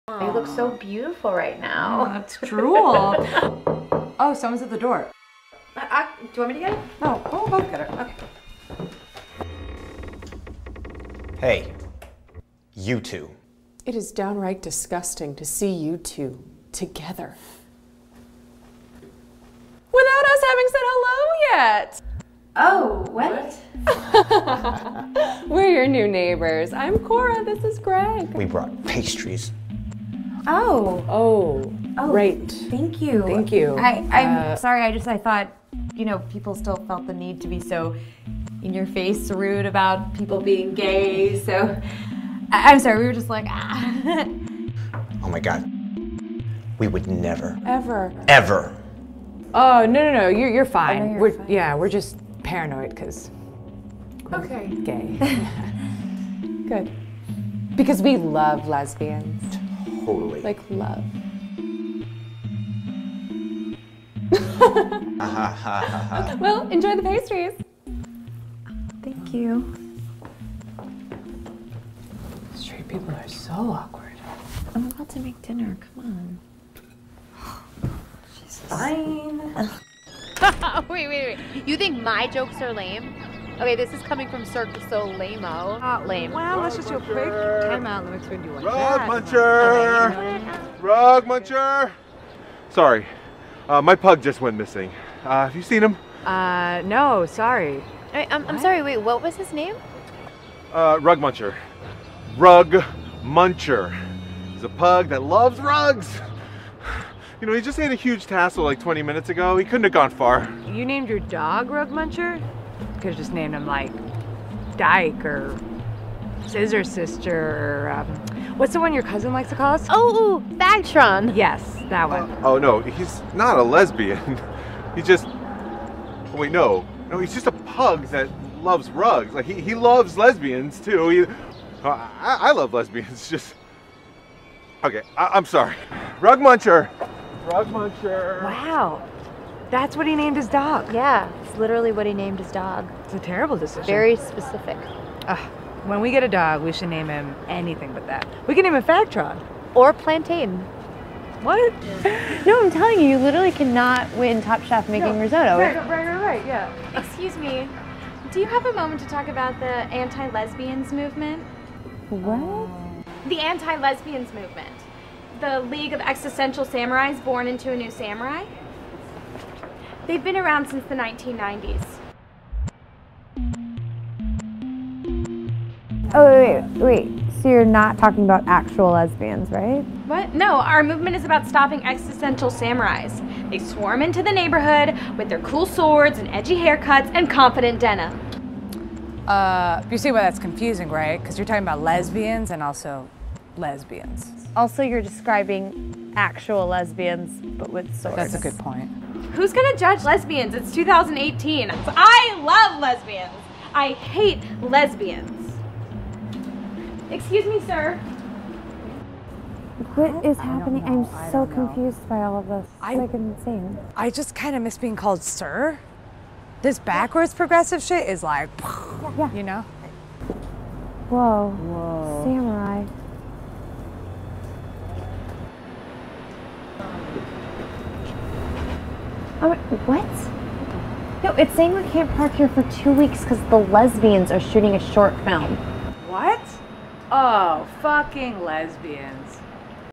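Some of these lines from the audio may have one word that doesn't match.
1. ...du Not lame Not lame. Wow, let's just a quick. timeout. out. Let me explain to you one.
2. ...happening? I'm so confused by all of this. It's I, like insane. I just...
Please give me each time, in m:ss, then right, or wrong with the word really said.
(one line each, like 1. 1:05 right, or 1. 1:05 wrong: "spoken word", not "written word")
1. 1:24 wrong: "Soleil", not "Not"
2. 3:30 right.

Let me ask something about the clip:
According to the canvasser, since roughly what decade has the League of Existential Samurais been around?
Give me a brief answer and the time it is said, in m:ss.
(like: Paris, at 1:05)
1990s, at 2:50.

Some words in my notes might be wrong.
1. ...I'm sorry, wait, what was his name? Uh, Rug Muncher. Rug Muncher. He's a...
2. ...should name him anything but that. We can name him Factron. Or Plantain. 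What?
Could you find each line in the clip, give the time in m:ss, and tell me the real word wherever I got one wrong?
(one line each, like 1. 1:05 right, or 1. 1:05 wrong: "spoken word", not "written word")
1. 1:38 right
2. 2:26 right.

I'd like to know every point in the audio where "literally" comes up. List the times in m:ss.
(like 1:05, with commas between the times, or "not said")
2:21, 2:33.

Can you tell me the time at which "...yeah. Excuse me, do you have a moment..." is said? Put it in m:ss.
2:36.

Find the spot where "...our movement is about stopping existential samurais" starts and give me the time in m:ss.
3:00.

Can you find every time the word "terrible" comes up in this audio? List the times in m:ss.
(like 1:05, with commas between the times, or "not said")
2:23.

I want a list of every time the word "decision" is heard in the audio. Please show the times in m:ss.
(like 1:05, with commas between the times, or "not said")
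2:23.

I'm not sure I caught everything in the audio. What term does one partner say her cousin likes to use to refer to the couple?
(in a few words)
Bagtron.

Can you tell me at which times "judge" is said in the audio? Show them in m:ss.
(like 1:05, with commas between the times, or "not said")
3:19.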